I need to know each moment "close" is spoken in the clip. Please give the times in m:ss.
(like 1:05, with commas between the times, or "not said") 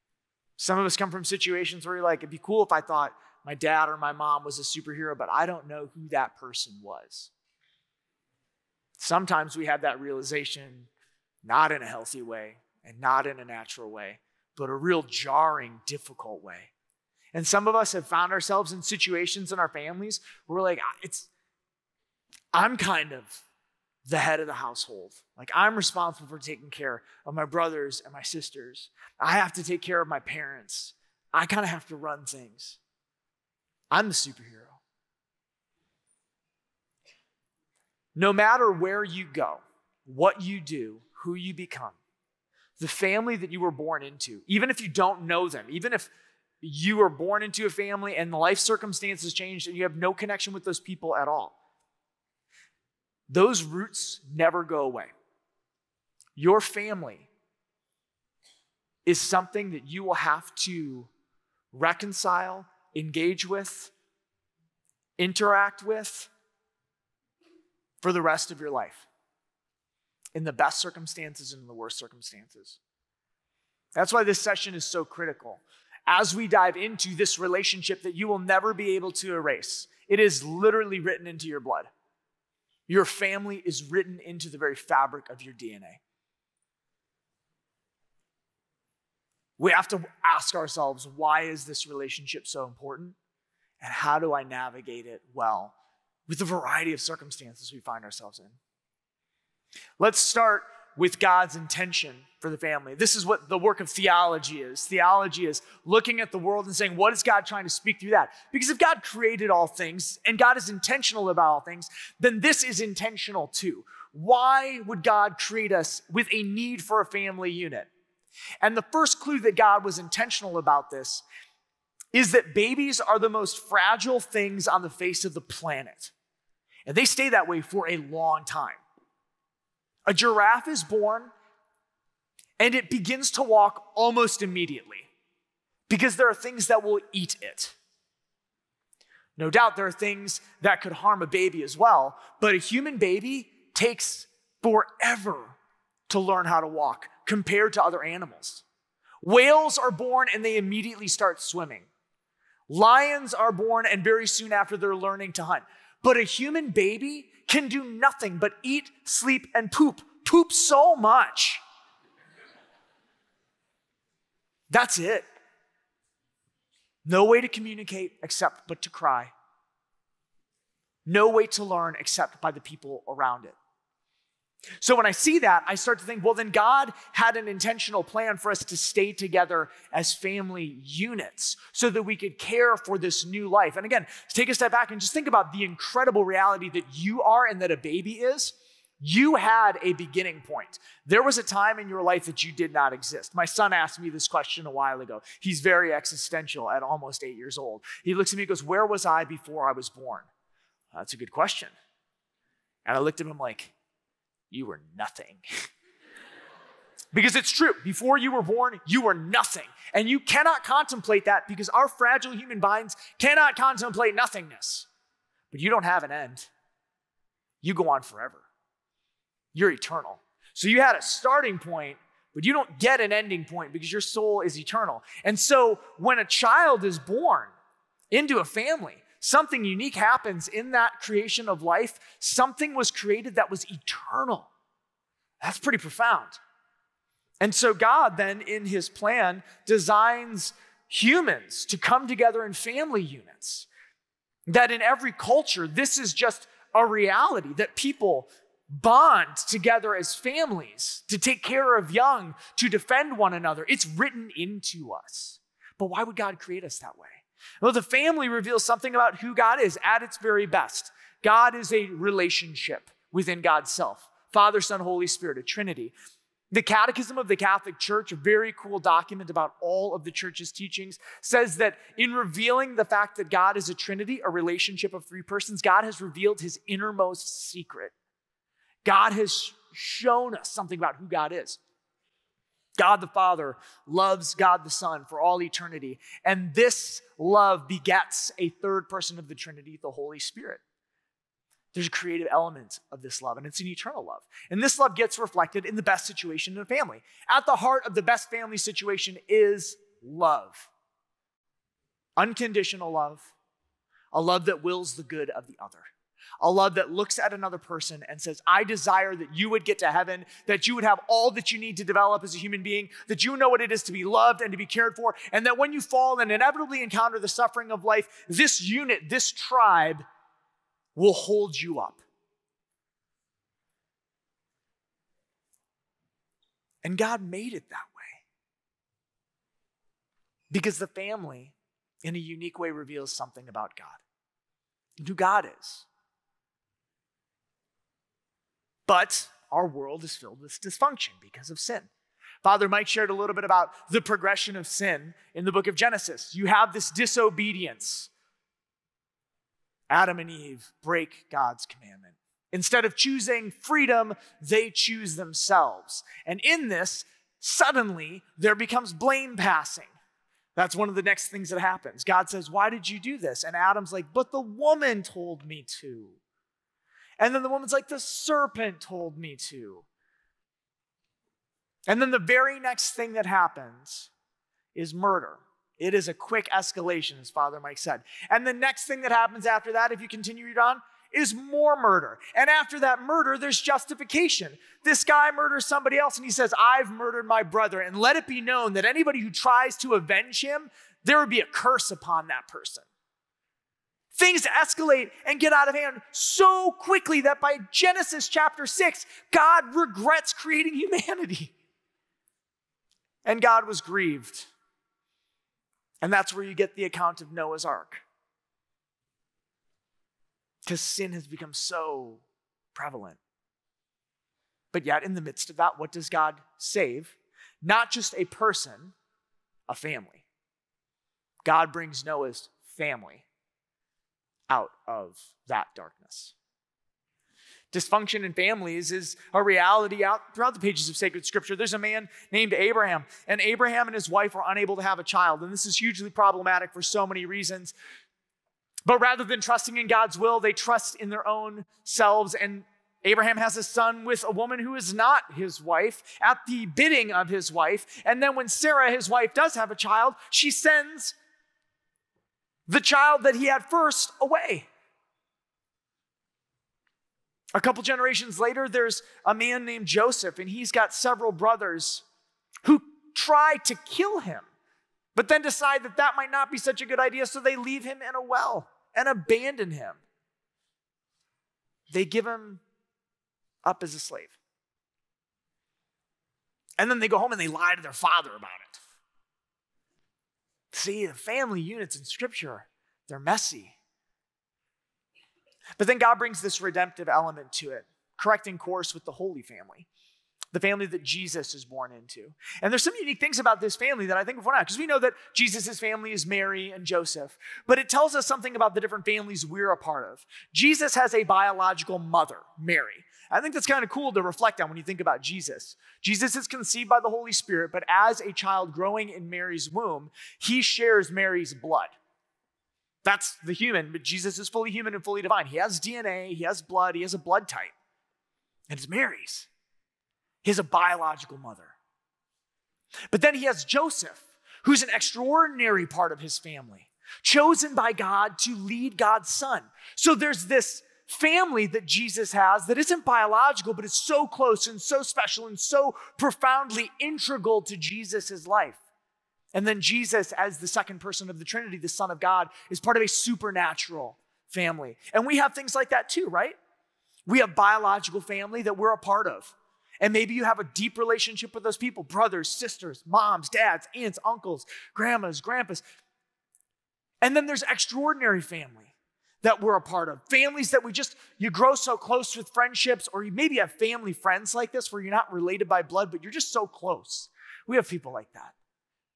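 8:54, 9:21, 9:26.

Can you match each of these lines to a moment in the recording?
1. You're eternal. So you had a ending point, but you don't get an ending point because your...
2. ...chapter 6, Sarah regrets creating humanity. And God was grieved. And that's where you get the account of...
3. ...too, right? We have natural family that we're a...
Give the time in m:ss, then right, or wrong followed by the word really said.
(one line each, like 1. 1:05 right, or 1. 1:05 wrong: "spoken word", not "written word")
1. 3:39 wrong: "starting", not "ending"
2. 6:38 wrong: "God", not "Sarah"
3. 9:06 wrong: "biological", not "natural".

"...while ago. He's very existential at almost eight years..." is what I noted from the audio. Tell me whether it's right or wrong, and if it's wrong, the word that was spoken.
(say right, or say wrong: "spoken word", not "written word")
right.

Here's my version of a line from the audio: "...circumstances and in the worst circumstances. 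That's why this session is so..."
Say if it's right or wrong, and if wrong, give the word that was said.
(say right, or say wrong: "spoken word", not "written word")
right.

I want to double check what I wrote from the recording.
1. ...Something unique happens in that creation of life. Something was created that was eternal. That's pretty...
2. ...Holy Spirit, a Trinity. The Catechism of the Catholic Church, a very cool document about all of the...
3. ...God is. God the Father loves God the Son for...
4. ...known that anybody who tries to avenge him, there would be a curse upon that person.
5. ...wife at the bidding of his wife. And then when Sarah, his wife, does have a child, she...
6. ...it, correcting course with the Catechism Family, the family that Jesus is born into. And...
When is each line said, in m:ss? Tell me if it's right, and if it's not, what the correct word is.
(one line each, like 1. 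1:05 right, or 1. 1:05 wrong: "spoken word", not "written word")
1. 3:49 right
2. 4:24 right
3. 4:41 right
4. 6:28 right
5. 7:25 right
6. 8:07 wrong: "Holy", not "Catechism".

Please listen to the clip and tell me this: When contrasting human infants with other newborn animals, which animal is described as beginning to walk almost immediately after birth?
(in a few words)
giraffe.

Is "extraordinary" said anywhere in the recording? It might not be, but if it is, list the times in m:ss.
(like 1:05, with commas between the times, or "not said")
8:44, 9:17.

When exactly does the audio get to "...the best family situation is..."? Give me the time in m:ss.
4:57.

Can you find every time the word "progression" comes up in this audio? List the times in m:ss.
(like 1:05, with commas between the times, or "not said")
5:44.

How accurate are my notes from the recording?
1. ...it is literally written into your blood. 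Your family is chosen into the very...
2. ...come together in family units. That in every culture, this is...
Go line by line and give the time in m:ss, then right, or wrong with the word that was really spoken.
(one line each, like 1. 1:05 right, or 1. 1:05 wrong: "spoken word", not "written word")
1. 1:20 wrong: "written", not "chosen"
2. 4:01 right.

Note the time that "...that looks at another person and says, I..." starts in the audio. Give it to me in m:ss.
5:06.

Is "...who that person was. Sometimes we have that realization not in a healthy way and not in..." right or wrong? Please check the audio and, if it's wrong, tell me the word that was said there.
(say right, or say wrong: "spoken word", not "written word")
right.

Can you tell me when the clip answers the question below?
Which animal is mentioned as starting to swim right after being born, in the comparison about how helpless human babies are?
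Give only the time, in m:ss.
2:29.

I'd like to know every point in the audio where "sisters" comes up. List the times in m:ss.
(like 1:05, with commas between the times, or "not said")
0:28, 9:12.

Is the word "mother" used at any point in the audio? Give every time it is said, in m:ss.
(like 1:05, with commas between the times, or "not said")
8:21, 8:41.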